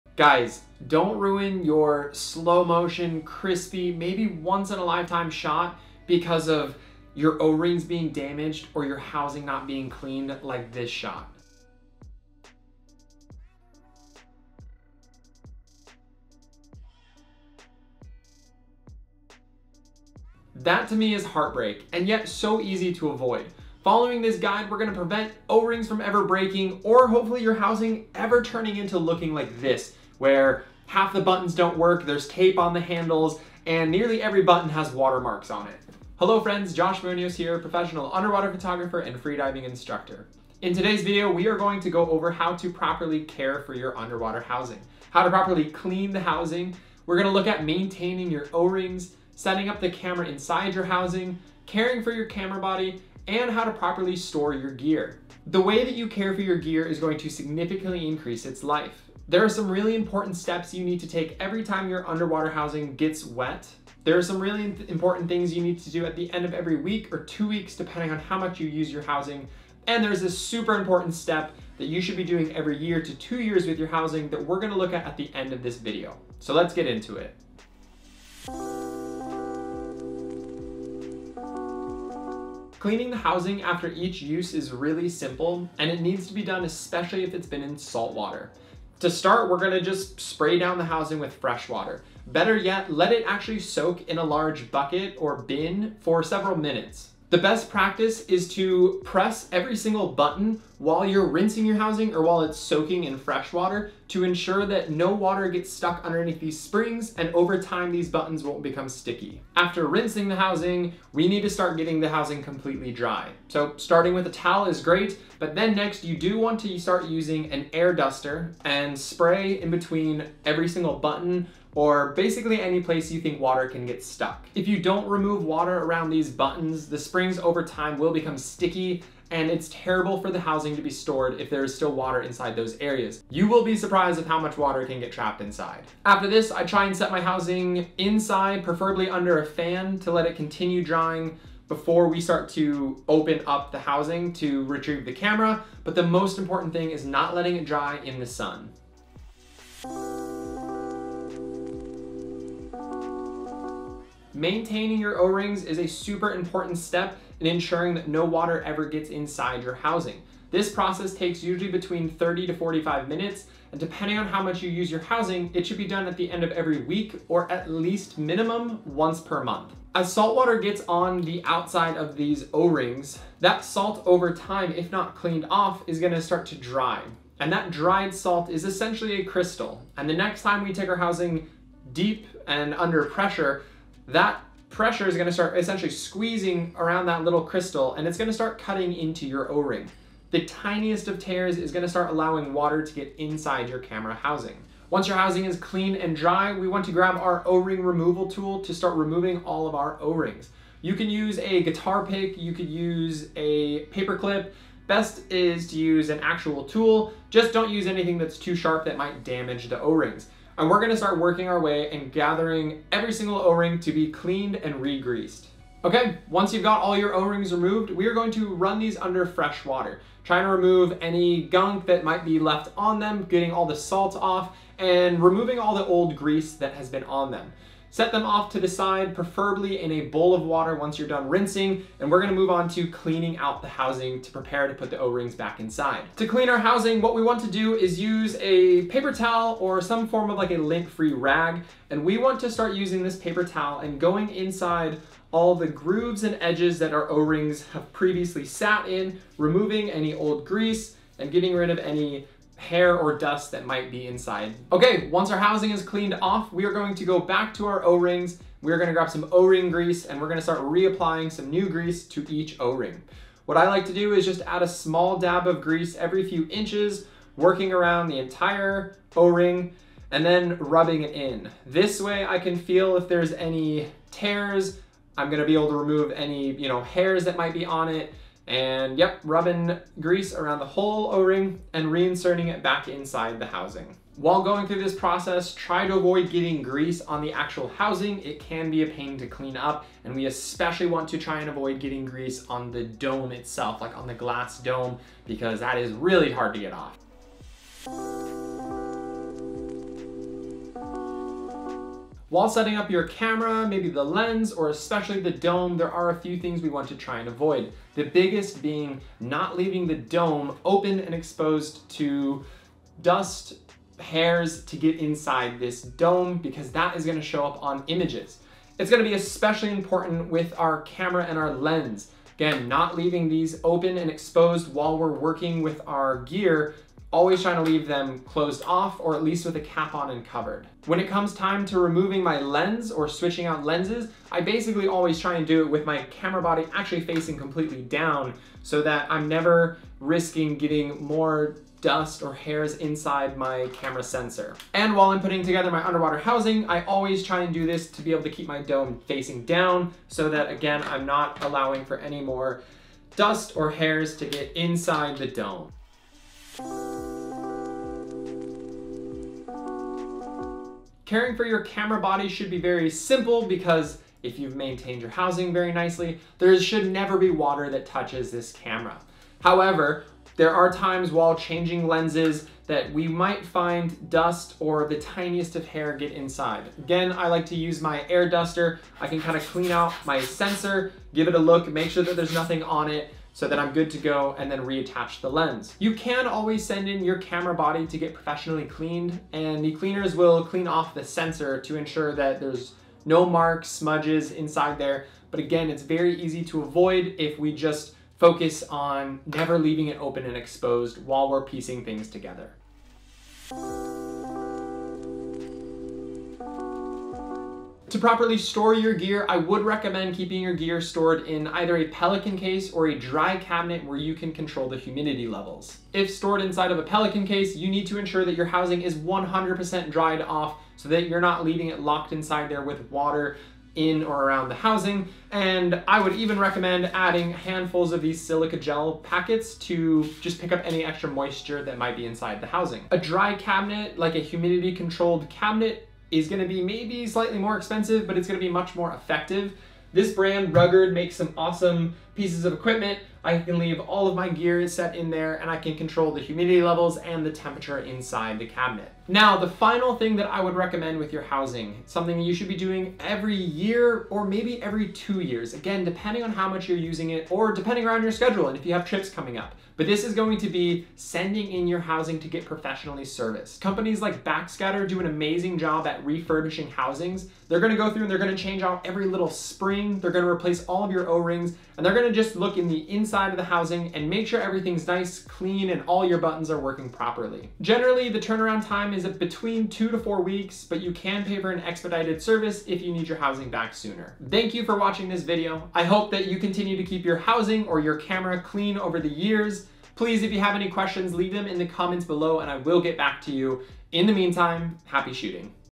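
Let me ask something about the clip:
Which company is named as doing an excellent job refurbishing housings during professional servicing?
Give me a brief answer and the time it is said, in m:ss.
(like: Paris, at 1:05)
Backscatter, at 7:44.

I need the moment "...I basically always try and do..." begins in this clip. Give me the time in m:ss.
5:34.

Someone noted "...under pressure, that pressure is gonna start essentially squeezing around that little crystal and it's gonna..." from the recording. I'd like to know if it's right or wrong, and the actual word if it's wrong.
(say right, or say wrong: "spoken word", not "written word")
right.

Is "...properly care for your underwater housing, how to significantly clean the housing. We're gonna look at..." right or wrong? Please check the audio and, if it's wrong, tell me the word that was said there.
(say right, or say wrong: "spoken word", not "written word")
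wrong: "properly", not "significantly".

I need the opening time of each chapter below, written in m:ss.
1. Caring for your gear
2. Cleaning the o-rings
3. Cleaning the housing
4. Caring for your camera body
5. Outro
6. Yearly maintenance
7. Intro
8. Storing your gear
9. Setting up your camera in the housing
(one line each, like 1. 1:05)
1. 0:55
2. 2:30
3. 1:18
4. 5:57
5. 8:05
6. 7:29
7. 0:21
8. 6:44
9. 4:58.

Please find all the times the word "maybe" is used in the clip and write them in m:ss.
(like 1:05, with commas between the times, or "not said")
0:03, 5:03, 7:16, 7:34.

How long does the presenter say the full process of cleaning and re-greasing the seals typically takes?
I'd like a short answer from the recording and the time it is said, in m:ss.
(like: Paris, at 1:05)
30 to 45 minutes, at 2:42.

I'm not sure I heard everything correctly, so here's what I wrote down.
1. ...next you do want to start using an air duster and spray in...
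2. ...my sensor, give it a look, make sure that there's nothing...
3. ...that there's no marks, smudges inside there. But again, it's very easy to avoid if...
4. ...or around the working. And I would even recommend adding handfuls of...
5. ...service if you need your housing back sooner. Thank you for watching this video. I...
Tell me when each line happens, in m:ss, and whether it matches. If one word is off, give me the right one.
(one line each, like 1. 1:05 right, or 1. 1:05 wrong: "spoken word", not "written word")
1. 1:55 right
2. 6:20 right
3. 6:32 right
4. 7:04 wrong: "housing", not "working"
5. 8:02 right.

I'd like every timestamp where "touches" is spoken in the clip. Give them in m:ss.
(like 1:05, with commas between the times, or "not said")
6:07.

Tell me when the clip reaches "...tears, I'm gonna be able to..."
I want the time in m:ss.
4:34.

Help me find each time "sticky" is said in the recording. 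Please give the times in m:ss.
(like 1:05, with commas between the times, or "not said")
1:48, 2:08.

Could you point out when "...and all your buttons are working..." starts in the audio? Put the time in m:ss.
7:55.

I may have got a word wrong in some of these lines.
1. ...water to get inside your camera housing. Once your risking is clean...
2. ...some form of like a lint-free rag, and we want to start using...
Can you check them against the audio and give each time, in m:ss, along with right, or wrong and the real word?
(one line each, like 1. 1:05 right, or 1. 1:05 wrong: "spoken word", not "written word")
1. 3:12 wrong: "housing", not "risking"
2. 3:59 right.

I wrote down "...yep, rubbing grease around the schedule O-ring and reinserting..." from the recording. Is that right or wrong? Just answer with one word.
wrong.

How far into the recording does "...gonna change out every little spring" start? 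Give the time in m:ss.
7:48.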